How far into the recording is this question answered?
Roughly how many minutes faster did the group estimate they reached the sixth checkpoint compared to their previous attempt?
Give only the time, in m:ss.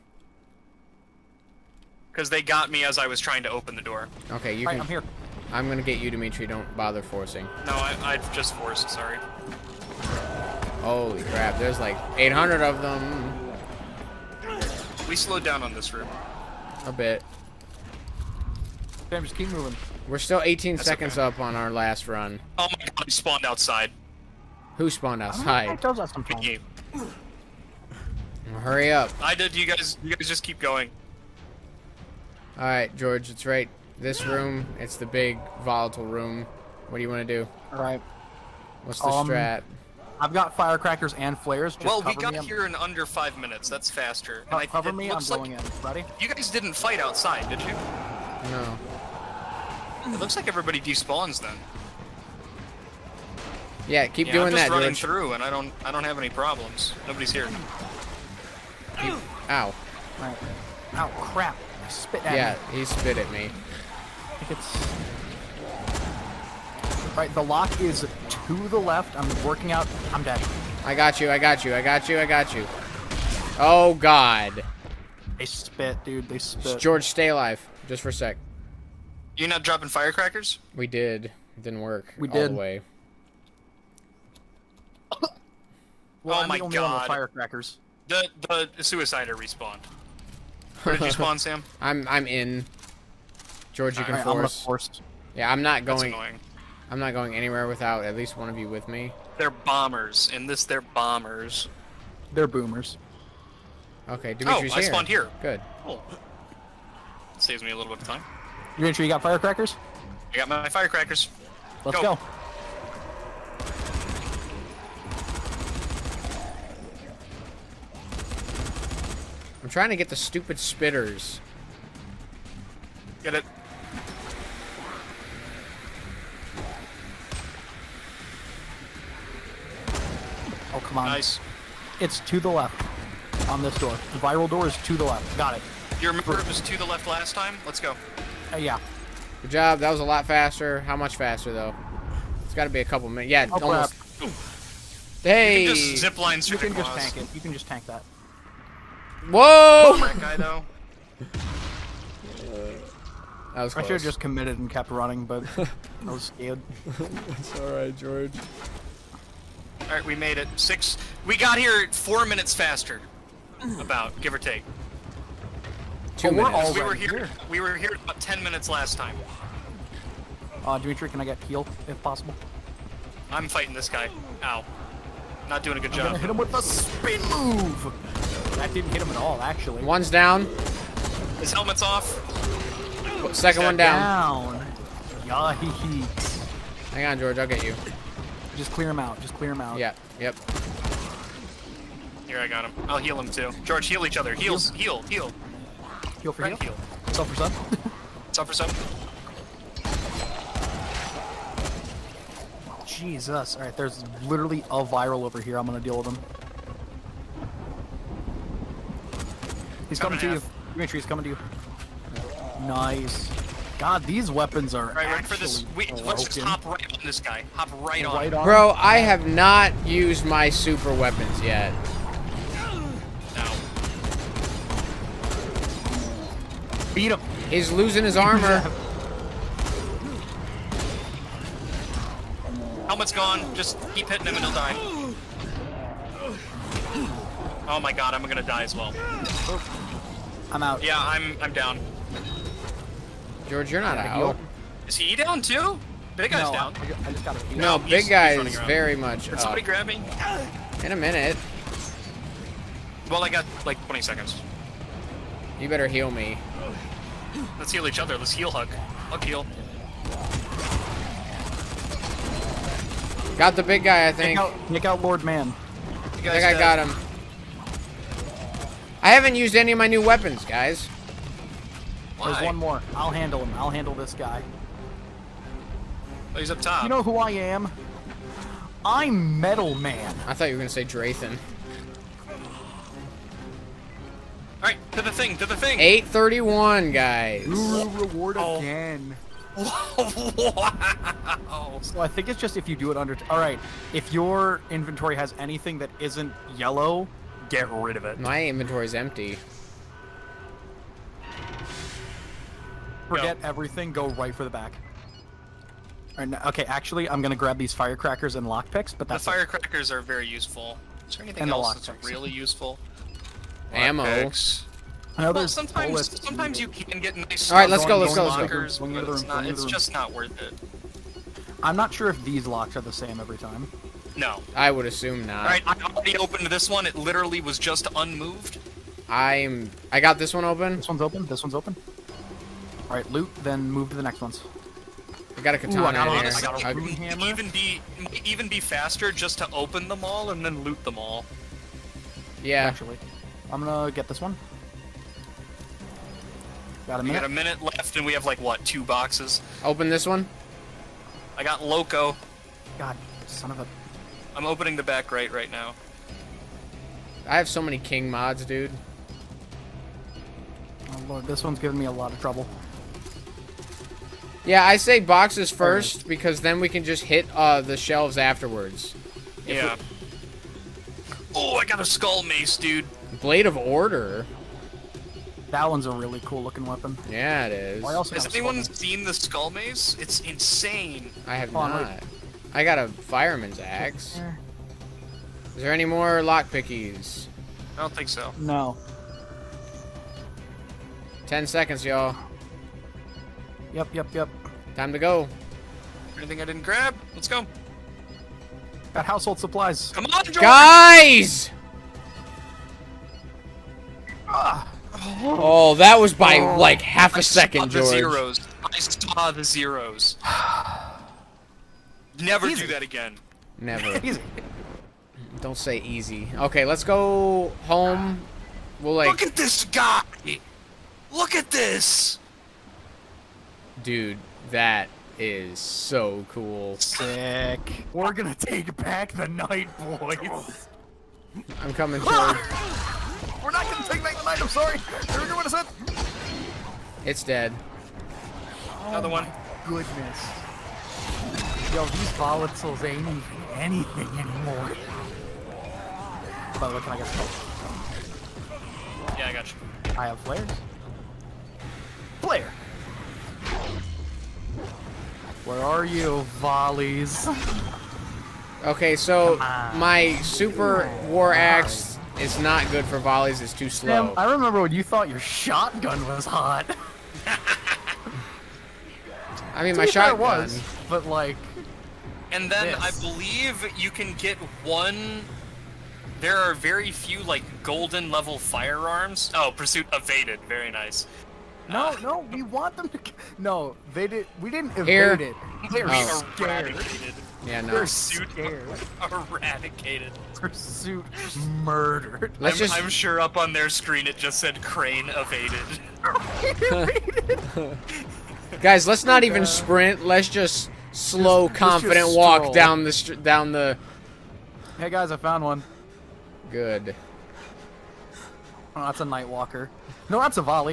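2:41.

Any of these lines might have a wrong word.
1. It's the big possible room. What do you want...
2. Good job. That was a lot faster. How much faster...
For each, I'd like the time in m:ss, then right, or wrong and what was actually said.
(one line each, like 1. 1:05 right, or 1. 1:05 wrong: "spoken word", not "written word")
1. 0:34 wrong: "volatile", not "possible"
2. 2:19 right.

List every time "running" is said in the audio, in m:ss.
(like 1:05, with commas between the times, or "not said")
0:54, 2:34.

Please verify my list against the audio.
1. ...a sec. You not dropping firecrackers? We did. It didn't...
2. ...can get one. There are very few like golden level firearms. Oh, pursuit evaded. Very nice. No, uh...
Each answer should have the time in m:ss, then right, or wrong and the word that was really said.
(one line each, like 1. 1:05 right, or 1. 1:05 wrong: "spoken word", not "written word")
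1. 1:18 right
2. 7:53 right.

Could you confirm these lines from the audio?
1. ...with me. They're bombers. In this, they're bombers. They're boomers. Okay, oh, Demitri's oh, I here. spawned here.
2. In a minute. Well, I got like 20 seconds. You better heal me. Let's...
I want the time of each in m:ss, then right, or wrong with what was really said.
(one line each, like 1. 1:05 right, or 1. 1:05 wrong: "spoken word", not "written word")
1. 1:38 right
2. 4:10 right.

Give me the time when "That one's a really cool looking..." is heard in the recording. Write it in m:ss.
6:15.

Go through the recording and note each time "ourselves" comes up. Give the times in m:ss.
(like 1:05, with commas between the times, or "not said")
not said.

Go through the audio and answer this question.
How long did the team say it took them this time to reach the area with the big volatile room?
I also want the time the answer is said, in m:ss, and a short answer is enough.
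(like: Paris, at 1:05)
under 5 minutes, at 0:42.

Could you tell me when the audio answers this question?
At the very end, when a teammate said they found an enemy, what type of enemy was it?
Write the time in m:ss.
8:29.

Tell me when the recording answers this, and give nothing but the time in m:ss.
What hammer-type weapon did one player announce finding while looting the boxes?
5:36.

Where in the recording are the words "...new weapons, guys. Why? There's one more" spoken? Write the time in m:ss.
4:29.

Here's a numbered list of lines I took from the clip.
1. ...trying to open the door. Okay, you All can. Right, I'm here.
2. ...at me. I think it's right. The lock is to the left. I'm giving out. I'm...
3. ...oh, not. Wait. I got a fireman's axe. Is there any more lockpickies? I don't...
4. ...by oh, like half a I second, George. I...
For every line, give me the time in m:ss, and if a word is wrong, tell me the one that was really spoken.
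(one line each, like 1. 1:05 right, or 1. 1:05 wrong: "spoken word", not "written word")
1. 0:03 right
2. 1:03 wrong: "working", not "giving"
3. 6:21 right
4. 6:46 right.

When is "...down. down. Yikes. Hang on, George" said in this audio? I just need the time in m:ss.
3:03.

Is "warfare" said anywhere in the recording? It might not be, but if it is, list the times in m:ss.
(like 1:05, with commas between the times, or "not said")
not said.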